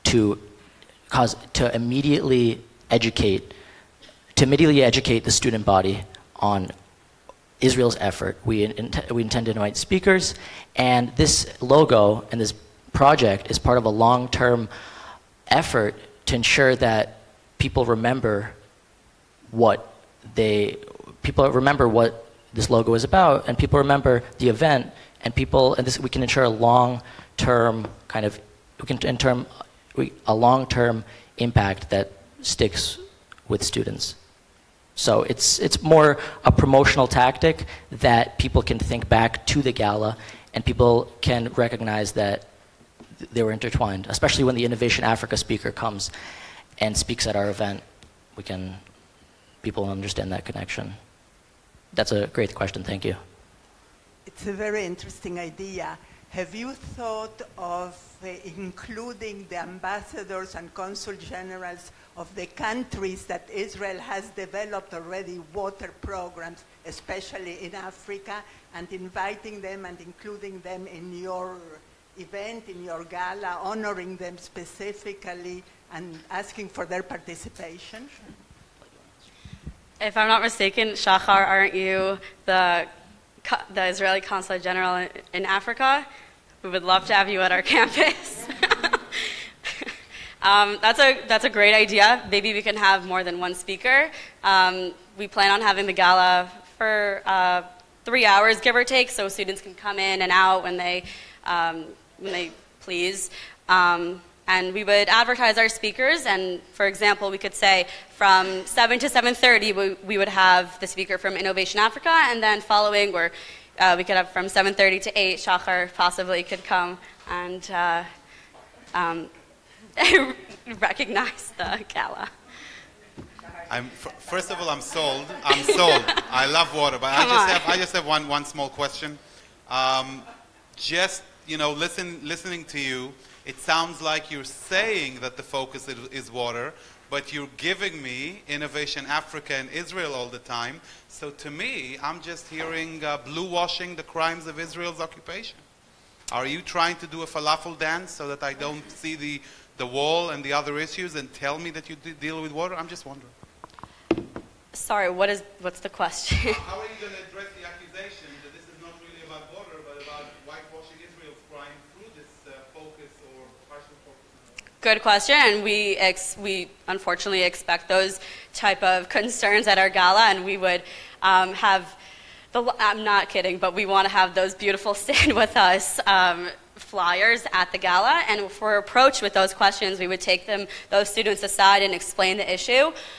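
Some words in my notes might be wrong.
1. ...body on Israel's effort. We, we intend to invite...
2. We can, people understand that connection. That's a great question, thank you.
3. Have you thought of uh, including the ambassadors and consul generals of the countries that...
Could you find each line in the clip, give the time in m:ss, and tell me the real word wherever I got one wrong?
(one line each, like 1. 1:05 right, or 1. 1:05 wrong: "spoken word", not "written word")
1. 0:05 right
2. 0:48 right
3. 0:56 right.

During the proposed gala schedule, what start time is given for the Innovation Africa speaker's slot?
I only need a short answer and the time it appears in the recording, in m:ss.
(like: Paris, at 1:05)
7:00, at 1:48.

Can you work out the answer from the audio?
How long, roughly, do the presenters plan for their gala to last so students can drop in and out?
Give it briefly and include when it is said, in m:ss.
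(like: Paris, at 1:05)
3 hours, at 1:38.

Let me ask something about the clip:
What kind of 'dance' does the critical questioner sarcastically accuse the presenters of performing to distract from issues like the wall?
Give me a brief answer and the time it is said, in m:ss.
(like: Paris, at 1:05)
falafel dance, at 2:27.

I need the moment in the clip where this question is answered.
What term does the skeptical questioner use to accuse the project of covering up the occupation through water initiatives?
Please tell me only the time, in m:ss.
2:23.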